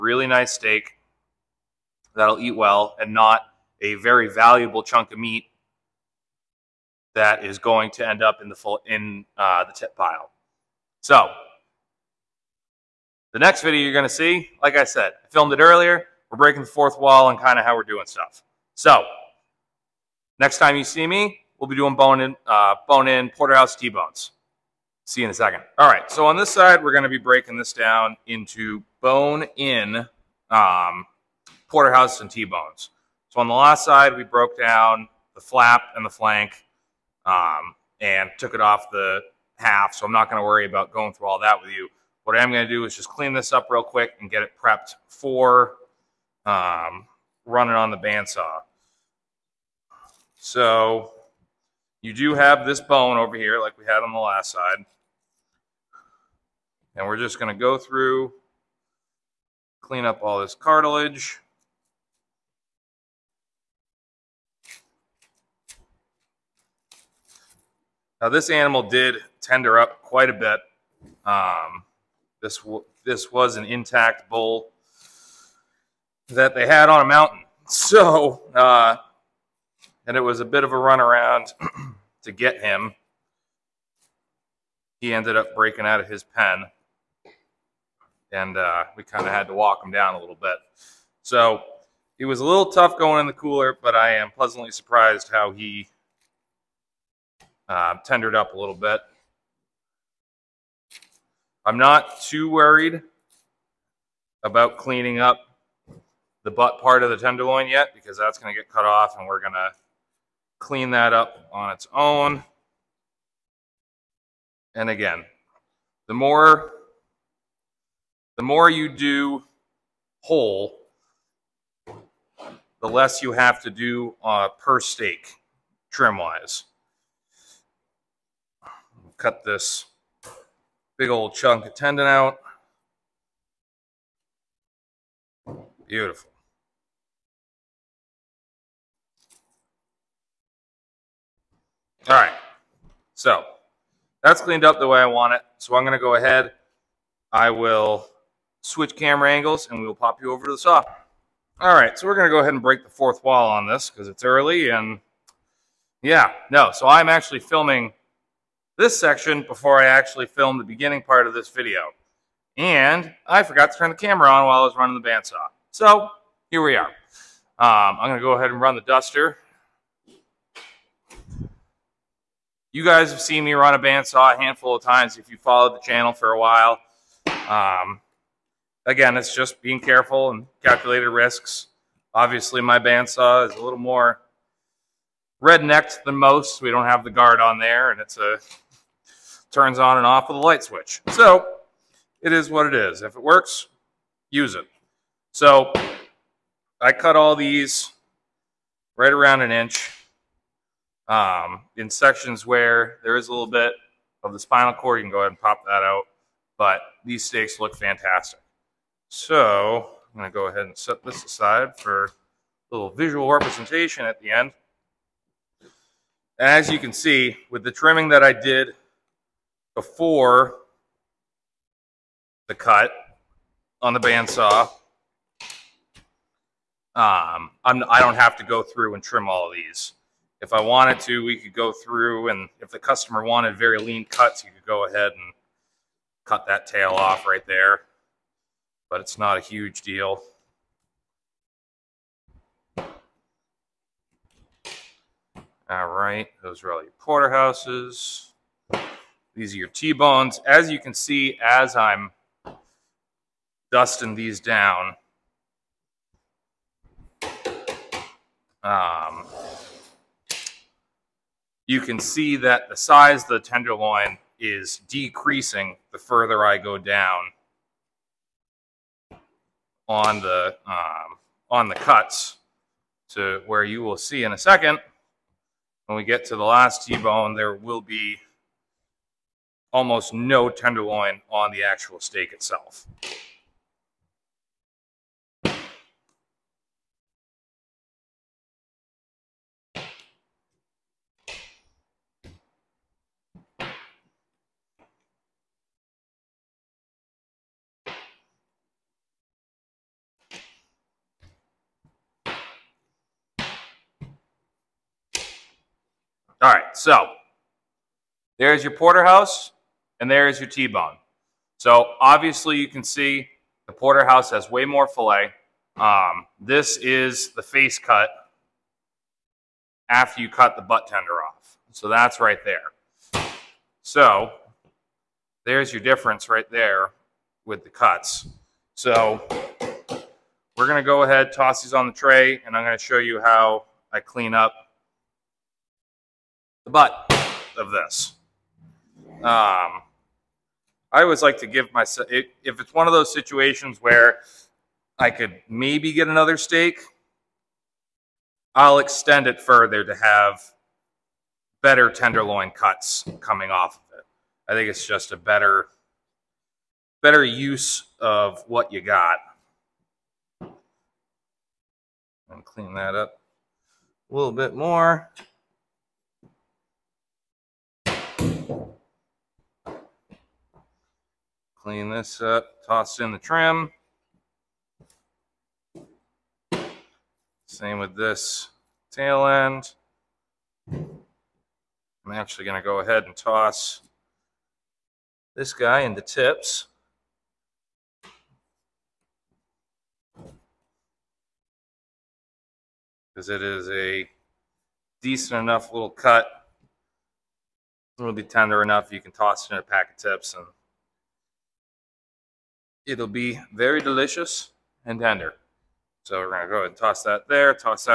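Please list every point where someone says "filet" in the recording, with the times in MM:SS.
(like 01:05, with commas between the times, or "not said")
05:14.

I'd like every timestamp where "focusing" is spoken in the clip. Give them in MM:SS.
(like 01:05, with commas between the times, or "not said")
not said.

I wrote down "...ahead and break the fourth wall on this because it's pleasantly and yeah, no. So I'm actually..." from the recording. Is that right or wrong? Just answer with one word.
wrong.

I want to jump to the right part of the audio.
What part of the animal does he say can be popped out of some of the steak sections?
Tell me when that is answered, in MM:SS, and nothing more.
03:24.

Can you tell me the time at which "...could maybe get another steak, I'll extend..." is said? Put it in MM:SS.
05:45.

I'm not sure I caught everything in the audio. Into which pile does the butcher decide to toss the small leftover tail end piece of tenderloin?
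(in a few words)
the tips.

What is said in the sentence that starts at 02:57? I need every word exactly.
Um, again, it's just being careful and calculated risks.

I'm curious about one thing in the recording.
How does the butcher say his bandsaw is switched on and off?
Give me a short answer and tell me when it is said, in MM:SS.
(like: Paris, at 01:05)
with a light switch, at 03:10.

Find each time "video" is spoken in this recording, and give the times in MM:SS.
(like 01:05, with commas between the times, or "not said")
00:13, 02:41.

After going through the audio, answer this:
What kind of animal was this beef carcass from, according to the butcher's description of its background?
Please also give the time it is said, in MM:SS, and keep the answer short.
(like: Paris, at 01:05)
intact bull, at 01:13.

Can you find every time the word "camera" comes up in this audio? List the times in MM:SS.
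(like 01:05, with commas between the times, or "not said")
02:28, 02:43.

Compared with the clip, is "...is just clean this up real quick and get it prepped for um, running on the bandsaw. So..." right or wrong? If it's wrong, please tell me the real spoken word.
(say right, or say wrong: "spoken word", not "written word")
right.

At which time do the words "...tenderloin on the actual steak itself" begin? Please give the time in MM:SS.
04:40.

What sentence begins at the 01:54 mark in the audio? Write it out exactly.
And again, the more the more you do whole, the less you have to do uh, per steak trim wise.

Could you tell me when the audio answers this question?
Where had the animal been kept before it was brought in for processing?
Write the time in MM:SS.
01:16.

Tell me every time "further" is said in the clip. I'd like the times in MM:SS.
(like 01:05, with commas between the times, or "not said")
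04:25, 05:49.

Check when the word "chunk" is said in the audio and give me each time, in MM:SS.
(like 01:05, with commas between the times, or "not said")
00:04, 02:11.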